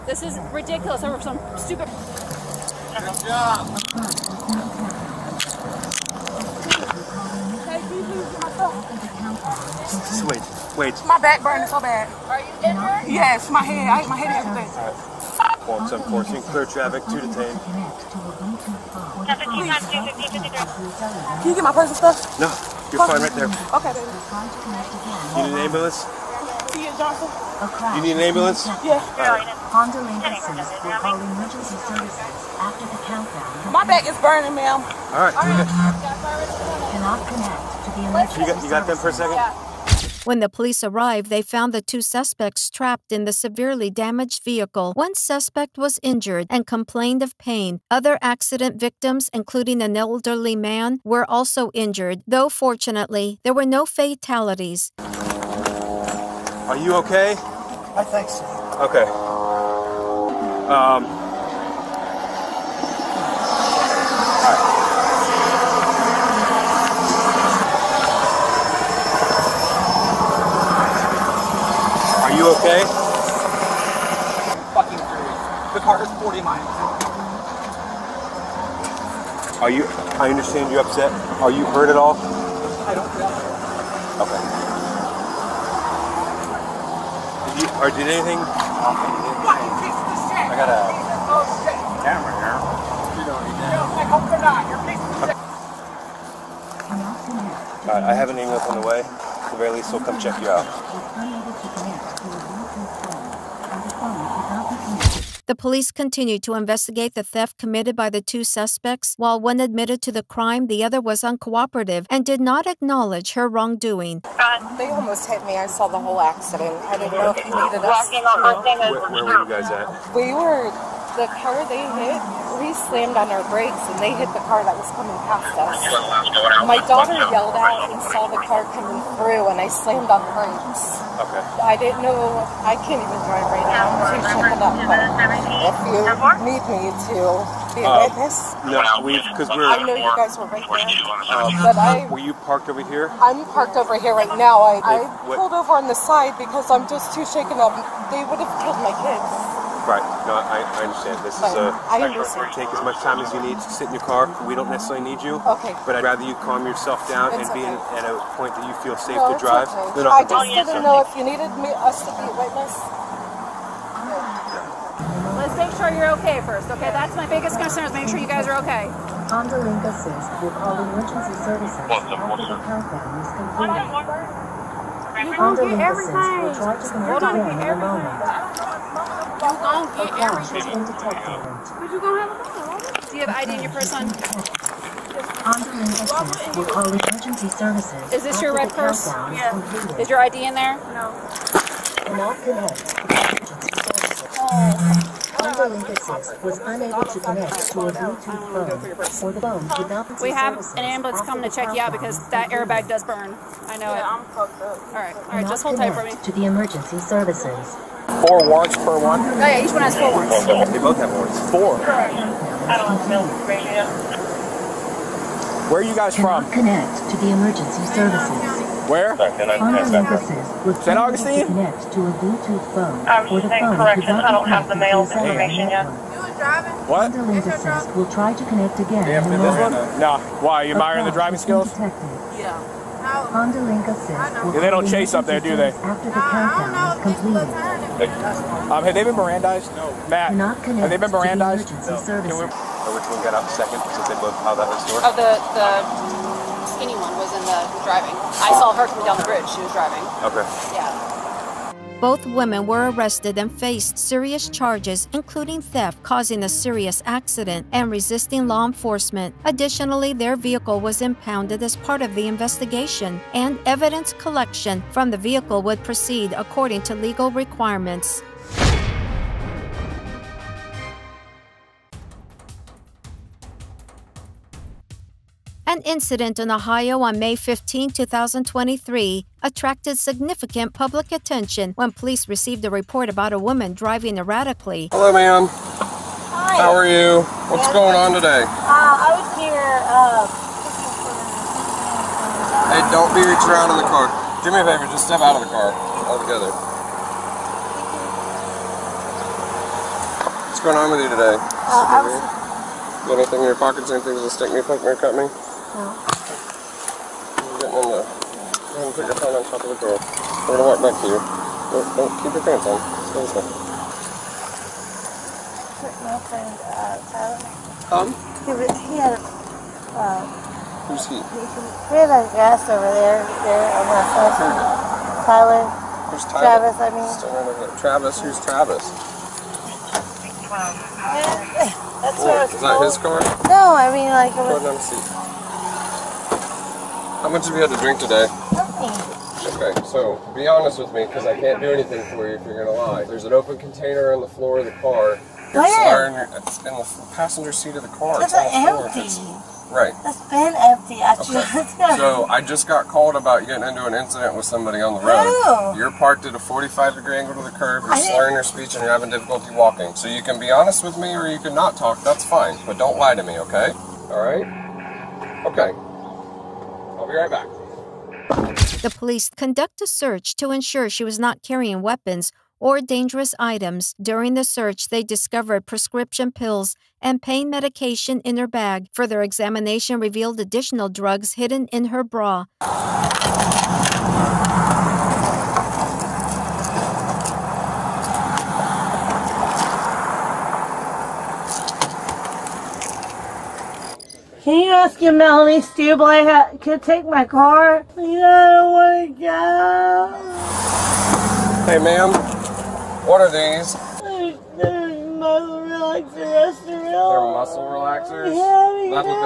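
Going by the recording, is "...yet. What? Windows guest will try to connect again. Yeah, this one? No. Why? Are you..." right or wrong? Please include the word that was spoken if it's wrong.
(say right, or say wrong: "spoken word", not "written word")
wrong: "assist", not "guest".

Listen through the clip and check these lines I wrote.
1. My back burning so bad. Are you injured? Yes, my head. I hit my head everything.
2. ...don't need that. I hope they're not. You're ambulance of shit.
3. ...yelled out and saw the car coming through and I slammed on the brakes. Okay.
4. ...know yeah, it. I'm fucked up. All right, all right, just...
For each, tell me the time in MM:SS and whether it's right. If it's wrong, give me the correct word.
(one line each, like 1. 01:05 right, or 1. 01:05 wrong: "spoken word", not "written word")
1. 00:11 right
2. 01:33 wrong: "piece", not "ambulance"
3. 02:07 right
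4. 03:23 right.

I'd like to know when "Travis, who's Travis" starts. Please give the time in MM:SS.
05:27.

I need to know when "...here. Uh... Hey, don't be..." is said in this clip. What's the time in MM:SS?
04:49.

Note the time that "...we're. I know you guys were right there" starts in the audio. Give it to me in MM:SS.
02:19.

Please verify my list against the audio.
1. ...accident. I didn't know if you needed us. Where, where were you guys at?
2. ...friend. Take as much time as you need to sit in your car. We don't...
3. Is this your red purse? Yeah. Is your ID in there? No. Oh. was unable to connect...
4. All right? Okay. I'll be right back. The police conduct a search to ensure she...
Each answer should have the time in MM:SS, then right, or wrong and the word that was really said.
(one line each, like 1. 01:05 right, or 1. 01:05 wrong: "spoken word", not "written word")
1. 01:56 right
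2. 02:32 wrong: "understand", not "friend"
3. 03:08 right
4. 06:04 right.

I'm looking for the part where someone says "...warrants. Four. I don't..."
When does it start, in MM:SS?
03:31.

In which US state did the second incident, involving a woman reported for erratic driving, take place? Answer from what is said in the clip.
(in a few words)
Ohio.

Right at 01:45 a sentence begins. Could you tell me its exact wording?
The police continued to investigate the theft committed by the two suspects.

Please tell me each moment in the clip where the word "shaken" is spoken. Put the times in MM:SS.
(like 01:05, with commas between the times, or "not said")
02:14, 02:27.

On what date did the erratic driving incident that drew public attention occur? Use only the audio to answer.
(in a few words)
May 15, 2023.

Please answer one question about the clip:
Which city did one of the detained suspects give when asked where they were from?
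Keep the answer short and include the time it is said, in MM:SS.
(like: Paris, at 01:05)
St. Augustine, at 03:40.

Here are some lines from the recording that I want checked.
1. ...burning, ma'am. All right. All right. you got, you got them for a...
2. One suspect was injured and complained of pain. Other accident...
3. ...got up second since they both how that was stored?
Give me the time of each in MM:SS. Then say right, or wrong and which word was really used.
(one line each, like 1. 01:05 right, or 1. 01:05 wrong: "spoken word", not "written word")
1. 00:34 right
2. 00:44 right
3. 04:03 right.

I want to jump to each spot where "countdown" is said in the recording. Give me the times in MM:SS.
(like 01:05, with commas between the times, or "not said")
00:33, 02:52.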